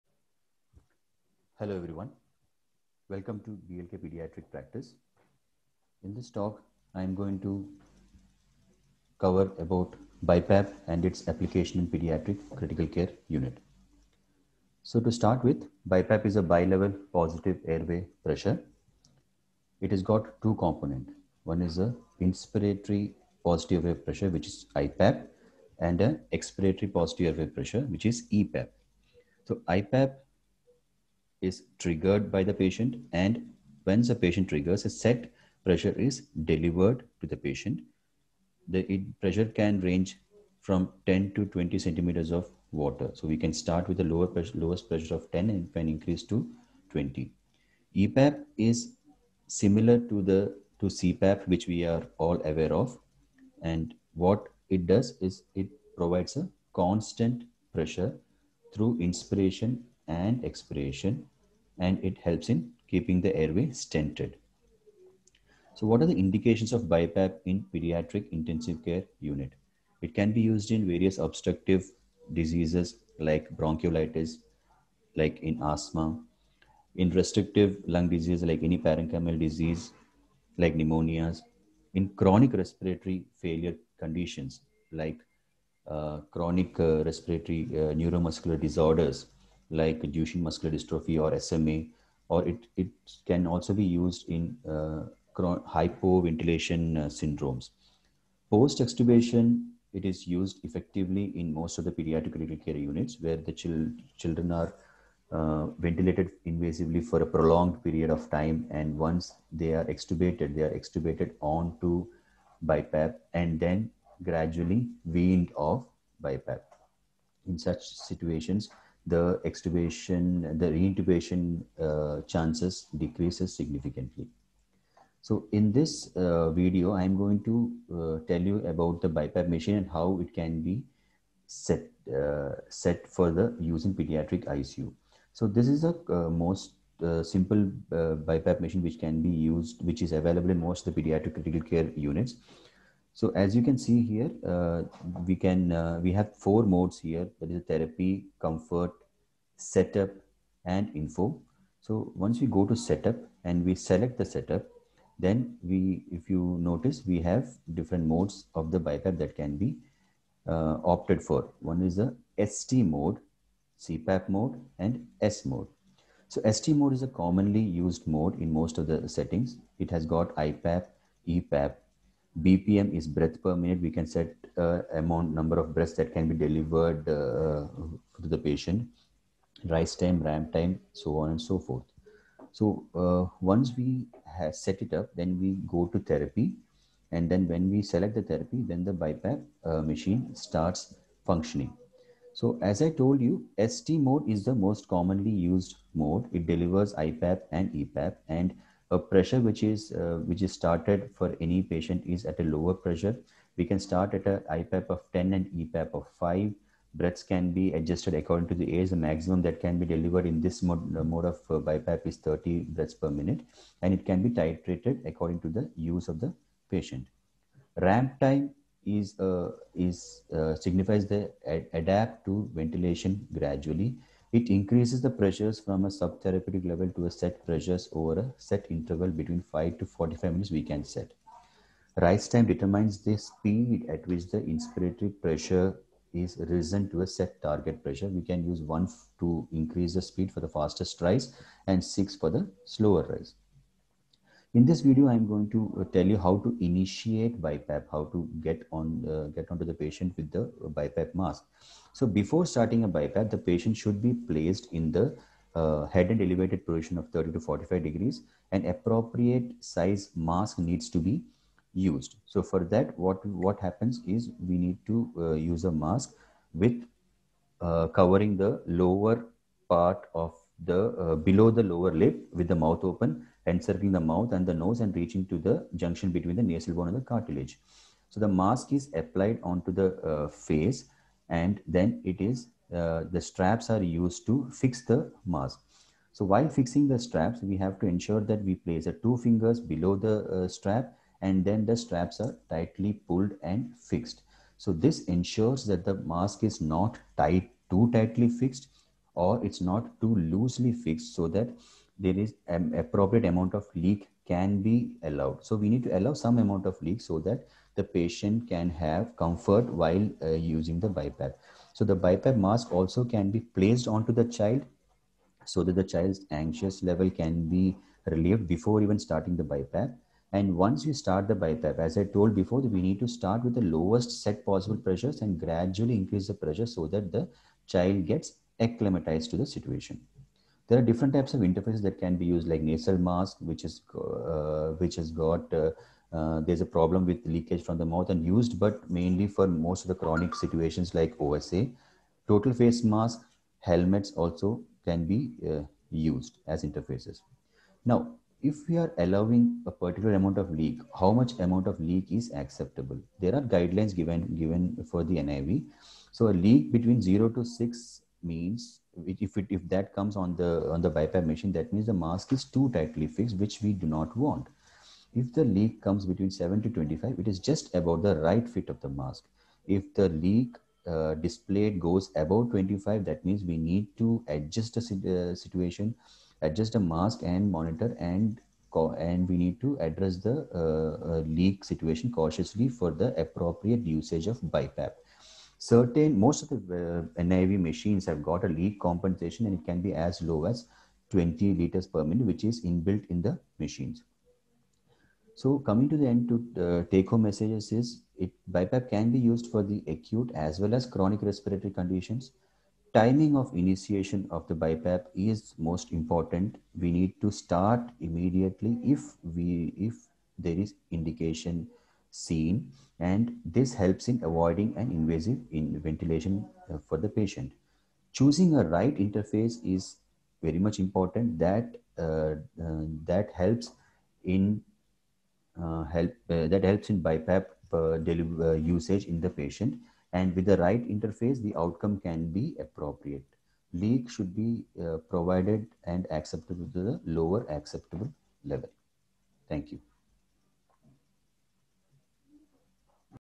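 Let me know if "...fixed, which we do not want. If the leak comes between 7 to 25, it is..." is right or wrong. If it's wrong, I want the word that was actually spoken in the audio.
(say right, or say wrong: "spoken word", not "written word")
right.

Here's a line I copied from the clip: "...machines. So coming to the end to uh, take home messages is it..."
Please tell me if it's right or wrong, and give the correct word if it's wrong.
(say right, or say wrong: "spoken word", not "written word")
right.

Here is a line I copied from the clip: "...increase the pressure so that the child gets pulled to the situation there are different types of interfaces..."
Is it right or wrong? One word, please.
wrong.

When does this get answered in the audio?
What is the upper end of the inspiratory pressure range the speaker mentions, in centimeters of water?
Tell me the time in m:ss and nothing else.
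0:45.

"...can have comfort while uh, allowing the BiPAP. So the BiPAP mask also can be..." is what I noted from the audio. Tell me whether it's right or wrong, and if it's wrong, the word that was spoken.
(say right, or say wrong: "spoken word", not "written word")
wrong: "using", not "allowing".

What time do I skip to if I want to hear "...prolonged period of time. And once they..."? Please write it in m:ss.
1:47.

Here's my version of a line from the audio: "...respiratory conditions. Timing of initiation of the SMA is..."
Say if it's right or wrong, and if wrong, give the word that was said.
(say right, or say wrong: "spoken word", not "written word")
wrong: "BiPAP", not "SMA".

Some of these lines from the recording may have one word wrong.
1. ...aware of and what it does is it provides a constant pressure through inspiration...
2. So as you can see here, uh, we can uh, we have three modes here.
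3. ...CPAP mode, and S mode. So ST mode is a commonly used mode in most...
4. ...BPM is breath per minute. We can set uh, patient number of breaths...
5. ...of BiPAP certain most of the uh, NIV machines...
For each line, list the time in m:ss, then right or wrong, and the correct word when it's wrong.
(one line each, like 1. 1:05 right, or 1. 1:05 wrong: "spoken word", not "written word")
1. 0:52 right
2. 2:23 wrong: "four", not "three"
3. 2:43 right
4. 2:52 wrong: "amount", not "patient"
5. 6:24 right.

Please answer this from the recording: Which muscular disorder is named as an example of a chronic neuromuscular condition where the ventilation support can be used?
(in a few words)
Duchenne muscular dystrophy.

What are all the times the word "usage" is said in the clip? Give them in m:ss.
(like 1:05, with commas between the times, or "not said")
6:23, 7:08.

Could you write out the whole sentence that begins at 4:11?
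So before starting a BiPAP, the patient should be placed in the uh, head and elevated position of 30 to 45 degrees.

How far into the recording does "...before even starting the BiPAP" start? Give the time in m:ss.
5:18.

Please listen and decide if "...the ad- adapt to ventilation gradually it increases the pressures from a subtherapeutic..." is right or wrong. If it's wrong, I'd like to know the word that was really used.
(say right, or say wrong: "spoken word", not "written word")
right.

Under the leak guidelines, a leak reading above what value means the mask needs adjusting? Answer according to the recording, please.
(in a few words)
25.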